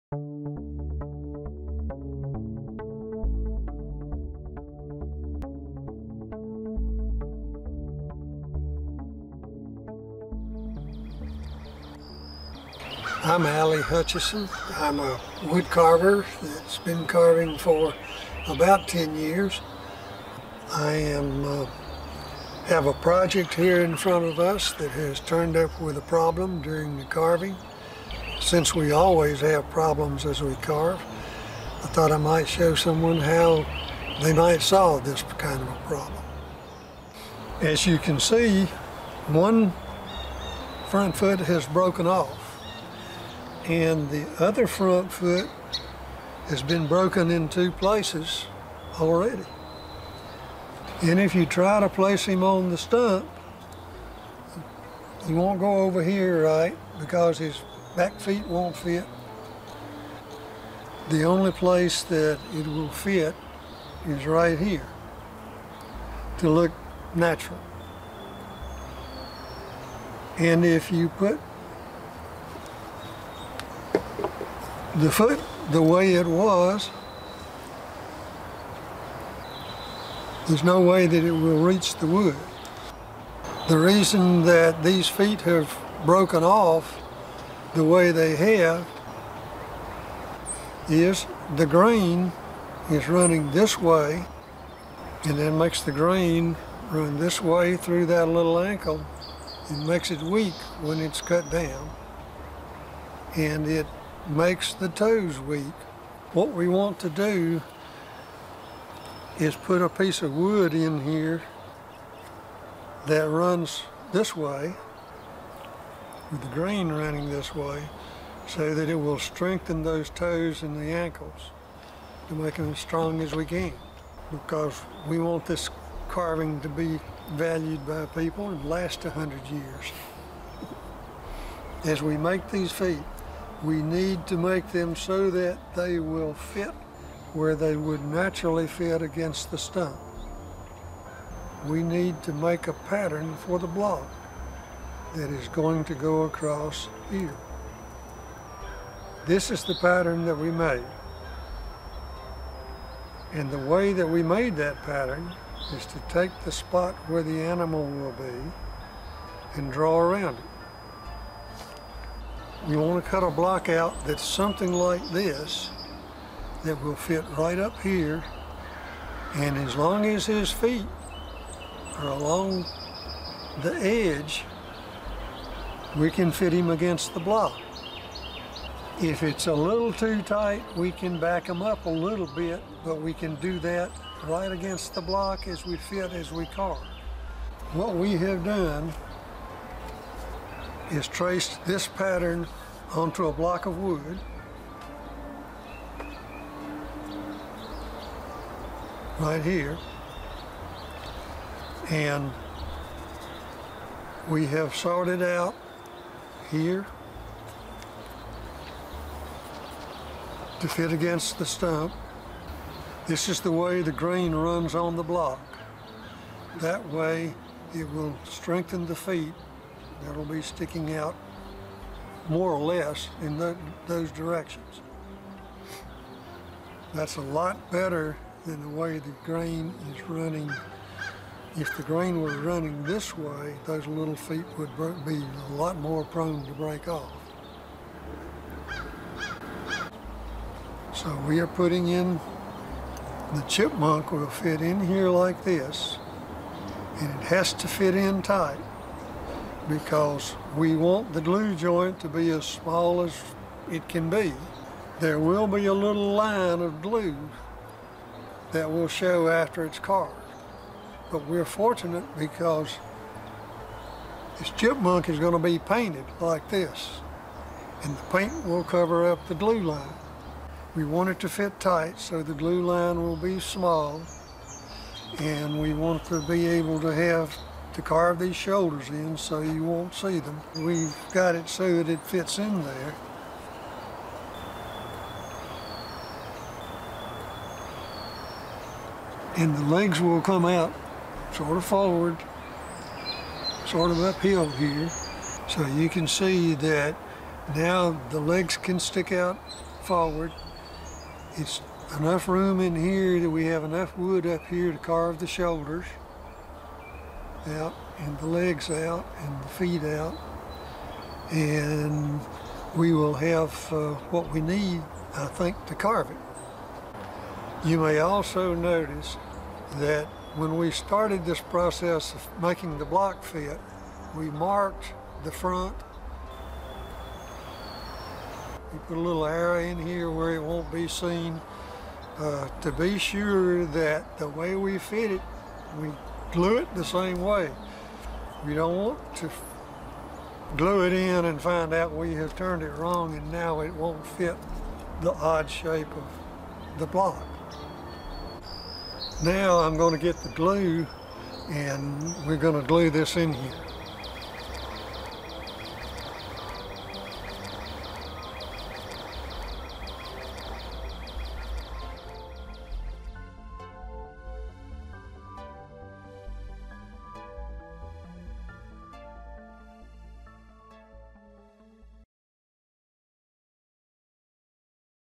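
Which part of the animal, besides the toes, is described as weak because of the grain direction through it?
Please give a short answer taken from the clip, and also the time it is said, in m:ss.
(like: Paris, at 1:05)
ankle, at 1:38.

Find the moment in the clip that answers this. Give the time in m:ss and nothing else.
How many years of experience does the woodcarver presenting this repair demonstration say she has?
0:18.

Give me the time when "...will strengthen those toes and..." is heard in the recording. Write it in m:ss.
1:58.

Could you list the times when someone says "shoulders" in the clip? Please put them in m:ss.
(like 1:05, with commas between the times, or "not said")
4:38, 5:05.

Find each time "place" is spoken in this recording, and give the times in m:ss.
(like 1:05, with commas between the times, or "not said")
0:47, 0:51, 1:01.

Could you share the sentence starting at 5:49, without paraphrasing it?
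Now I'm going to get the glue and we're going to glue this in here.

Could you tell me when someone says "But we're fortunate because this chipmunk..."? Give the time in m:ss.
4:21.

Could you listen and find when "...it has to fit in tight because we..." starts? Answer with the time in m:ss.
4:07.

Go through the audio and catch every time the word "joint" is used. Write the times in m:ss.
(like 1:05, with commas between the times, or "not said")
4:11.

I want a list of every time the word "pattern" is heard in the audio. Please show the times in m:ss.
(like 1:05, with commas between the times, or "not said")
2:22, 2:29, 2:34, 3:11.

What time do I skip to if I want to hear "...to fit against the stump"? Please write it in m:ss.
3:30.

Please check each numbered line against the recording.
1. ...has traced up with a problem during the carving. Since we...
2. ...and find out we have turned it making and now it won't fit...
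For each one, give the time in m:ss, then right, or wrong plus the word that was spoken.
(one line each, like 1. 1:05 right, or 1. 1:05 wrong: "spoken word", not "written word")
1. 0:24 wrong: "turned", not "traced"
2. 5:41 wrong: "wrong", not "making".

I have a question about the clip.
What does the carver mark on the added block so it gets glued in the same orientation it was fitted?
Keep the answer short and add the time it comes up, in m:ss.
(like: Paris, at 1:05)
the front, at 5:25.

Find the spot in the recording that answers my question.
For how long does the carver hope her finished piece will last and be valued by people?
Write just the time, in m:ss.
2:09.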